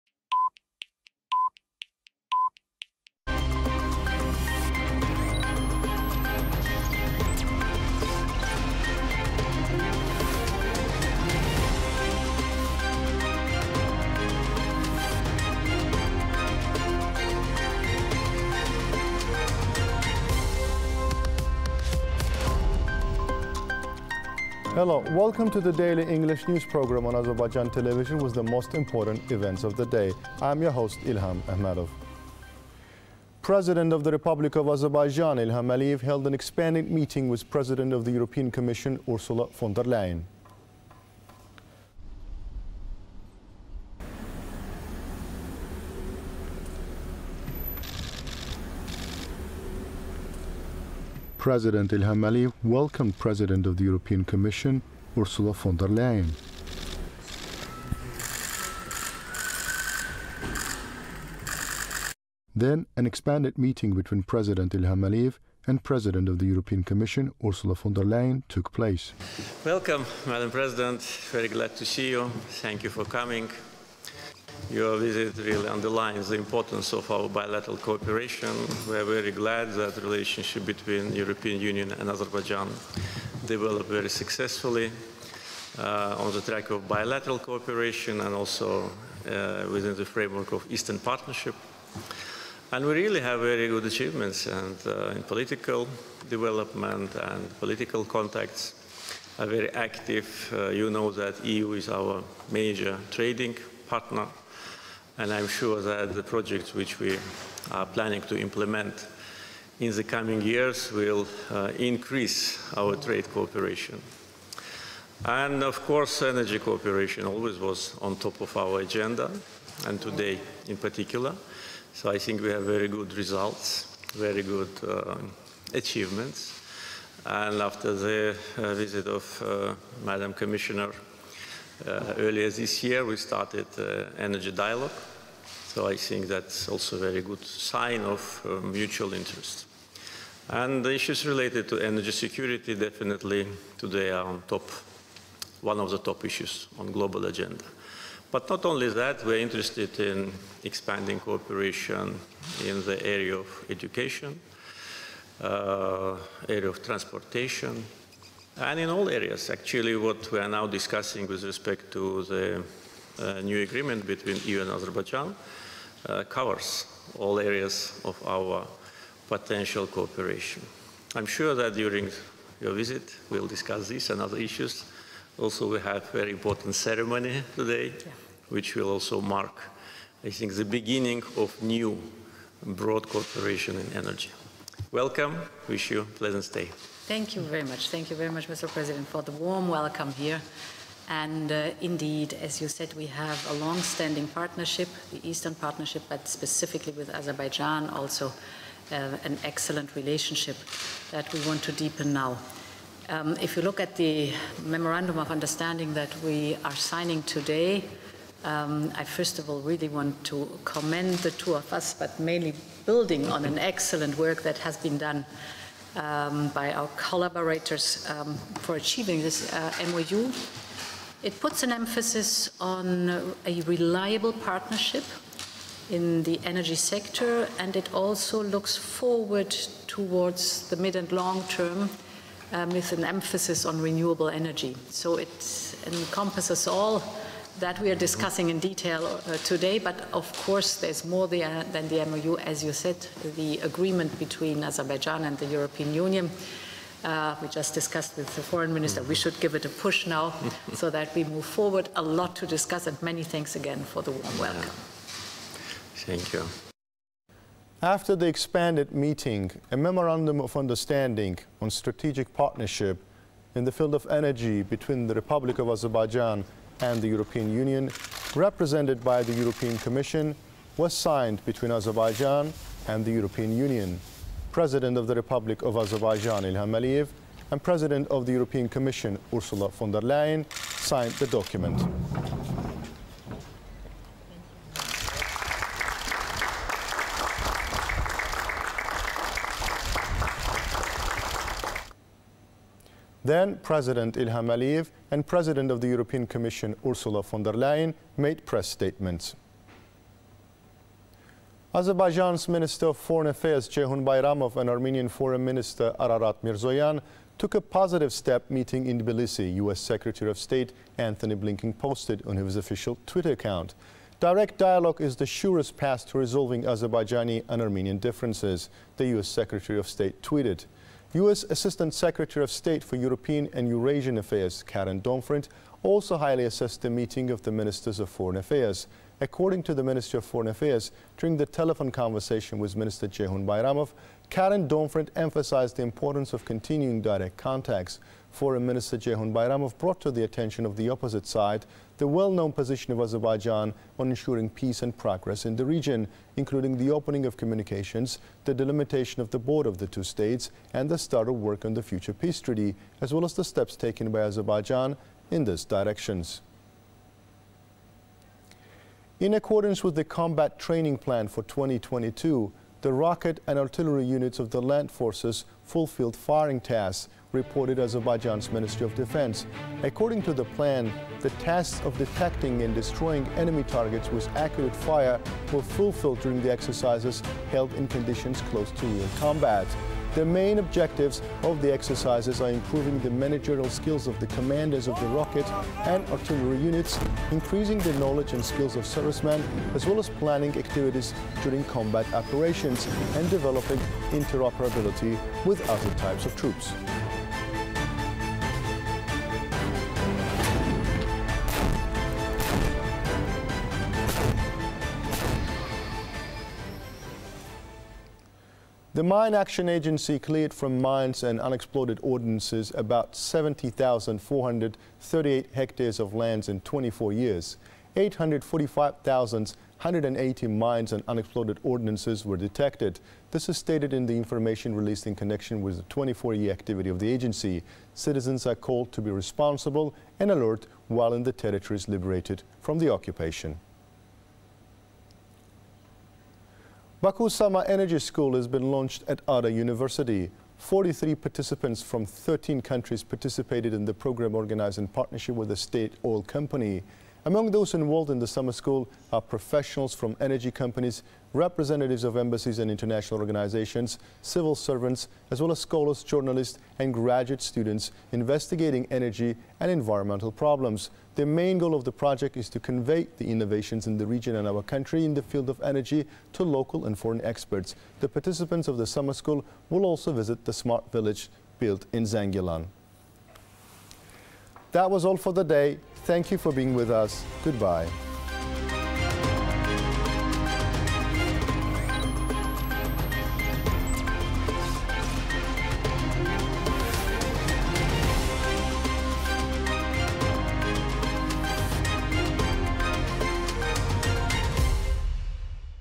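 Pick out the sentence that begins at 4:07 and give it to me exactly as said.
Uh, we just discussed with the foreign minister.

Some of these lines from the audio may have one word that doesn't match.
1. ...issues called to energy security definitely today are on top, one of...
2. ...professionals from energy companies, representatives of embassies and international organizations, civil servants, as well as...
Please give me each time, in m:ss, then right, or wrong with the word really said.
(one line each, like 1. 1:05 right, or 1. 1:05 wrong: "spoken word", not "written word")
1. 2:20 wrong: "related", not "called"
2. 7:29 right.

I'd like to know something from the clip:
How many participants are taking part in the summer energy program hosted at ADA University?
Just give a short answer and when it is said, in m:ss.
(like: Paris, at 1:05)
43, at 7:20.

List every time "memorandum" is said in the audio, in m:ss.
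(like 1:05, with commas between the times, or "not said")
3:24, 4:19.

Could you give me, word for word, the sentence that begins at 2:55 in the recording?
Also, we have a very important ceremony today, yeah.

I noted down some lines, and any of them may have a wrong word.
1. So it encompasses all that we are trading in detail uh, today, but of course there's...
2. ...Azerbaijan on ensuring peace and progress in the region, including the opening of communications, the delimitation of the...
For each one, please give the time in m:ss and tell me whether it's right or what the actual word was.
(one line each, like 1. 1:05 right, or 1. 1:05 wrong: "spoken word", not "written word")
1. 3:54 wrong: "discussing", not "trading"
2. 5:43 right.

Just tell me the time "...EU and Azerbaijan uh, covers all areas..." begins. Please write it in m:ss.
2:44.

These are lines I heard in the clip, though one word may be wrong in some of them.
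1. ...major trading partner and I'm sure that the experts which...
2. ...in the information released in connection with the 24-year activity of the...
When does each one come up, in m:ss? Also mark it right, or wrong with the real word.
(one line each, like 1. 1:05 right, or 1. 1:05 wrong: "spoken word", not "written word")
1. 1:42 wrong: "projects", not "experts"
2. 7:03 right.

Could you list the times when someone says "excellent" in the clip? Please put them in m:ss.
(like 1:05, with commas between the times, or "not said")
3:19, 3:33.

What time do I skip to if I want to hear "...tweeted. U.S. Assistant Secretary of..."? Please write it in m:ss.
5:20.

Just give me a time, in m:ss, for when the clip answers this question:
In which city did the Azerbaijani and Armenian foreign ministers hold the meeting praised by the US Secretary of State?
5:09.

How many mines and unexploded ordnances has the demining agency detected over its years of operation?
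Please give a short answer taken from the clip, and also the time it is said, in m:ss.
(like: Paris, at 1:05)
845,180, at 6:57.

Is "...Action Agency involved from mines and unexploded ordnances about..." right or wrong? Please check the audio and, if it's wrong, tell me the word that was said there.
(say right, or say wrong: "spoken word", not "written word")
wrong: "cleared", not "involved".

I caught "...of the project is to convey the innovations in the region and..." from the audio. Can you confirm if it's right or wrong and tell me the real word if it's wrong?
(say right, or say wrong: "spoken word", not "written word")
right.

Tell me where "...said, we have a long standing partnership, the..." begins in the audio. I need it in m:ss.
3:12.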